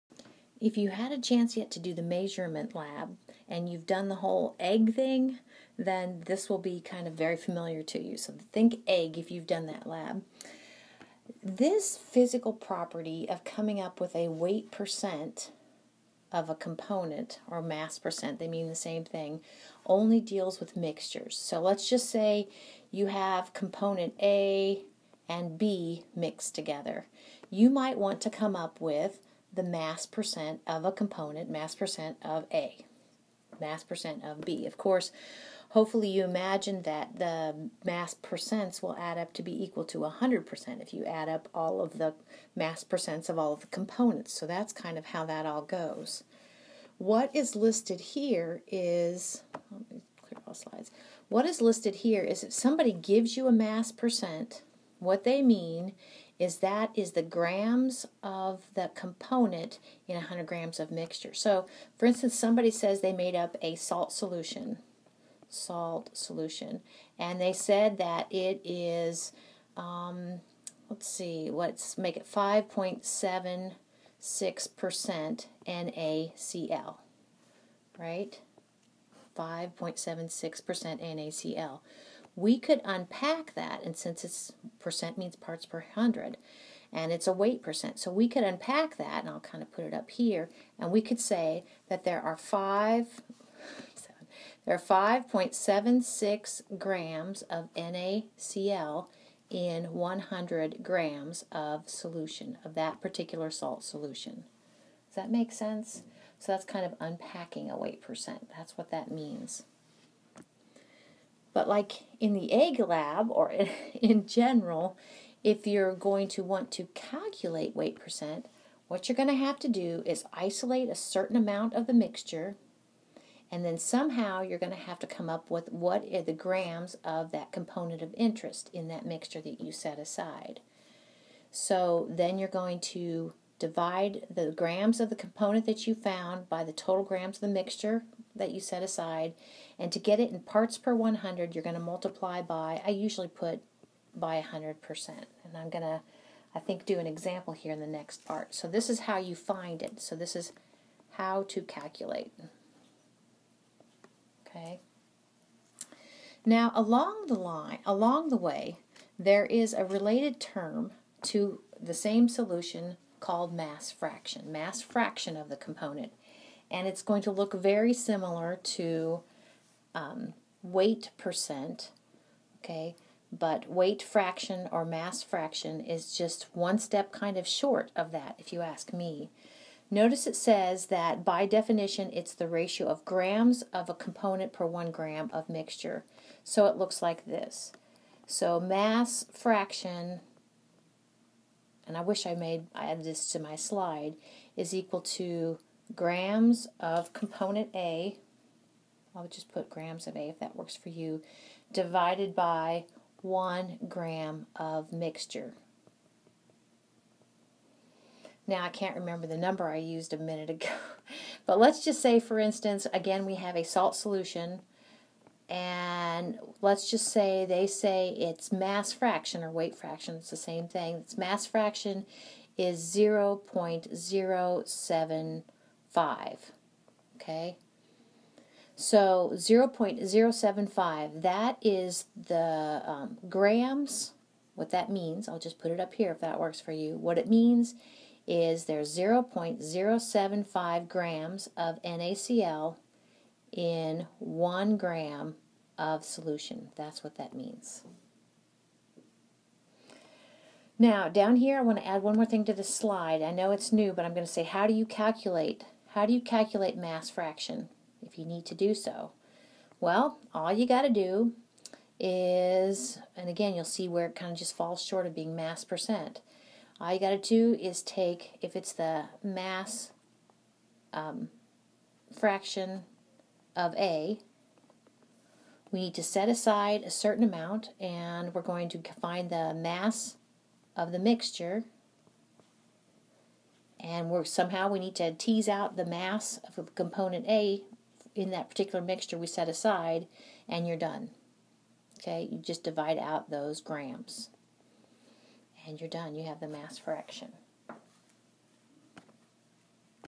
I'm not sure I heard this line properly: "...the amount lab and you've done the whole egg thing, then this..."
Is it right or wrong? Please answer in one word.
wrong.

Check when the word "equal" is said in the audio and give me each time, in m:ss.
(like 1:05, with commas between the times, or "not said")
0:39, 3:14.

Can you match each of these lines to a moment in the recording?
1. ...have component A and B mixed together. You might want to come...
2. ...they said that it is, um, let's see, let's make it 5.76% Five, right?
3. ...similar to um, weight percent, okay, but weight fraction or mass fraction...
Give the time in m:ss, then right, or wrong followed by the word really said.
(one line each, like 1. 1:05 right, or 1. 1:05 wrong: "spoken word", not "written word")
1. 0:23 right
2. 1:07 wrong: "NaCl", not "Five"
3. 2:47 right.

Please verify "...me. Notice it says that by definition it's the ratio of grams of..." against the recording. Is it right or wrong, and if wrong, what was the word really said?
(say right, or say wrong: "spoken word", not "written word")
right.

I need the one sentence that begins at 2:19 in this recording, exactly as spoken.
And to get it in parts per 100, you're going to multiply by, I usually put by 100%.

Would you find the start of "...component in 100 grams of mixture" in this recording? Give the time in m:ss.
0:58.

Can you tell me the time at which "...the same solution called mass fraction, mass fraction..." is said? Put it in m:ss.
2:41.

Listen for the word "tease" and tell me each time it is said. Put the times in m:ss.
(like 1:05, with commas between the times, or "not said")
4:45.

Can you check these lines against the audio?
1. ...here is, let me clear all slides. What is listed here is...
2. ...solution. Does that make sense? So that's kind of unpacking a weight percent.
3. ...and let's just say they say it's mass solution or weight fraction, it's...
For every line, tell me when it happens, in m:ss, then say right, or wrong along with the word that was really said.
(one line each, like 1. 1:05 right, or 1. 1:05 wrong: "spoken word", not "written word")
1. 0:47 right
2. 1:43 right
3. 3:35 wrong: "fraction", not "solution".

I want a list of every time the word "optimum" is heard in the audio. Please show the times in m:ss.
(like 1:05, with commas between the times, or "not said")
not said.